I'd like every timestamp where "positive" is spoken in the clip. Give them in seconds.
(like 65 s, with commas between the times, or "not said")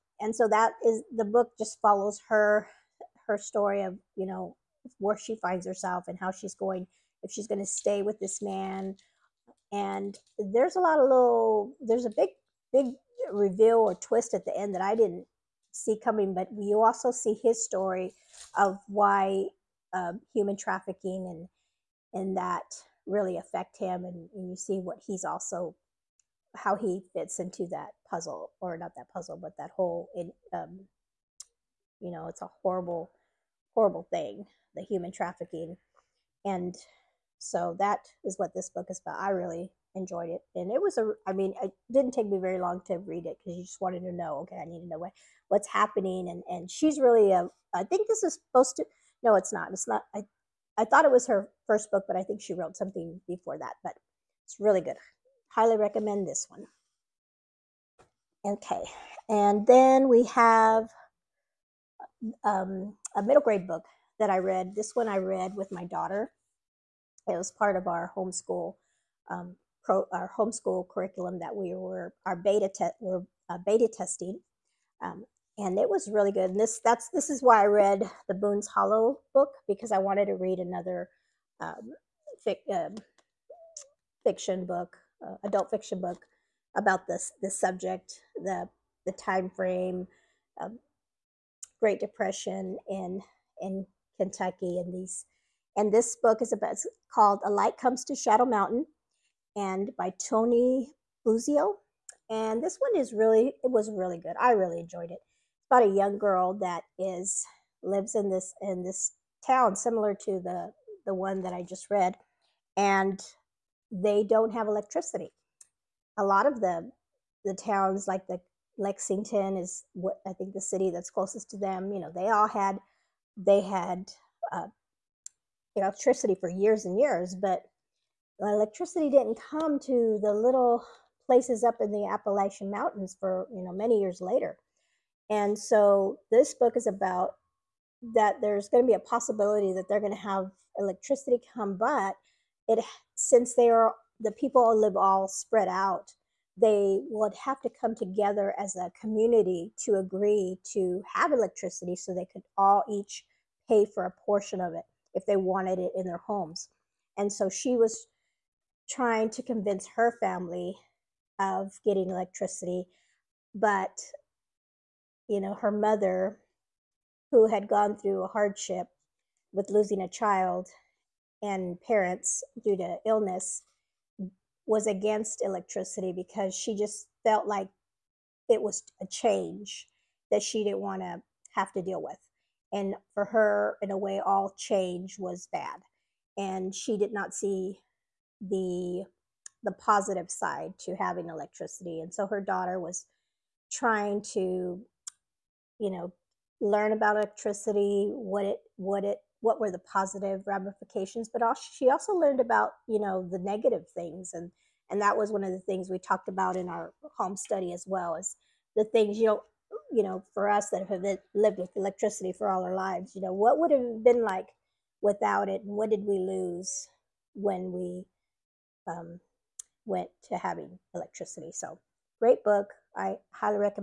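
189 s, 199 s.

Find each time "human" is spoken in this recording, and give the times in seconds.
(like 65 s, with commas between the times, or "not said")
20 s, 34 s.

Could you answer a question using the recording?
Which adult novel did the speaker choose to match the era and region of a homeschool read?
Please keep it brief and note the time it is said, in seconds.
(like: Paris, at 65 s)
Boone's Hollow, at 78 s.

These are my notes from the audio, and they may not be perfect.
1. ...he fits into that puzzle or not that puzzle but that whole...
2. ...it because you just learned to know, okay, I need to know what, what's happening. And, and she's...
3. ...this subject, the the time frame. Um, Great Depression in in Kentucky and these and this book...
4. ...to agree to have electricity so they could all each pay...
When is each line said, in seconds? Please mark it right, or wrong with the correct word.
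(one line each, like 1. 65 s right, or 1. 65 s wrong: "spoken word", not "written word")
1. 26 s right
2. 43 s wrong: "wanted", not "learned"
3. 87 s right
4. 149 s right.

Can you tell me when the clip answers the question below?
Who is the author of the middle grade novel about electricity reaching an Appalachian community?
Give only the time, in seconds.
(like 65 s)
100 s.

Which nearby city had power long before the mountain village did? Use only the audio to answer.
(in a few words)
Lexington.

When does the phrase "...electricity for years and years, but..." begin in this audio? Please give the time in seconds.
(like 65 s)
125 s.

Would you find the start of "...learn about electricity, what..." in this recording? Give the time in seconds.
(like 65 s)
196 s.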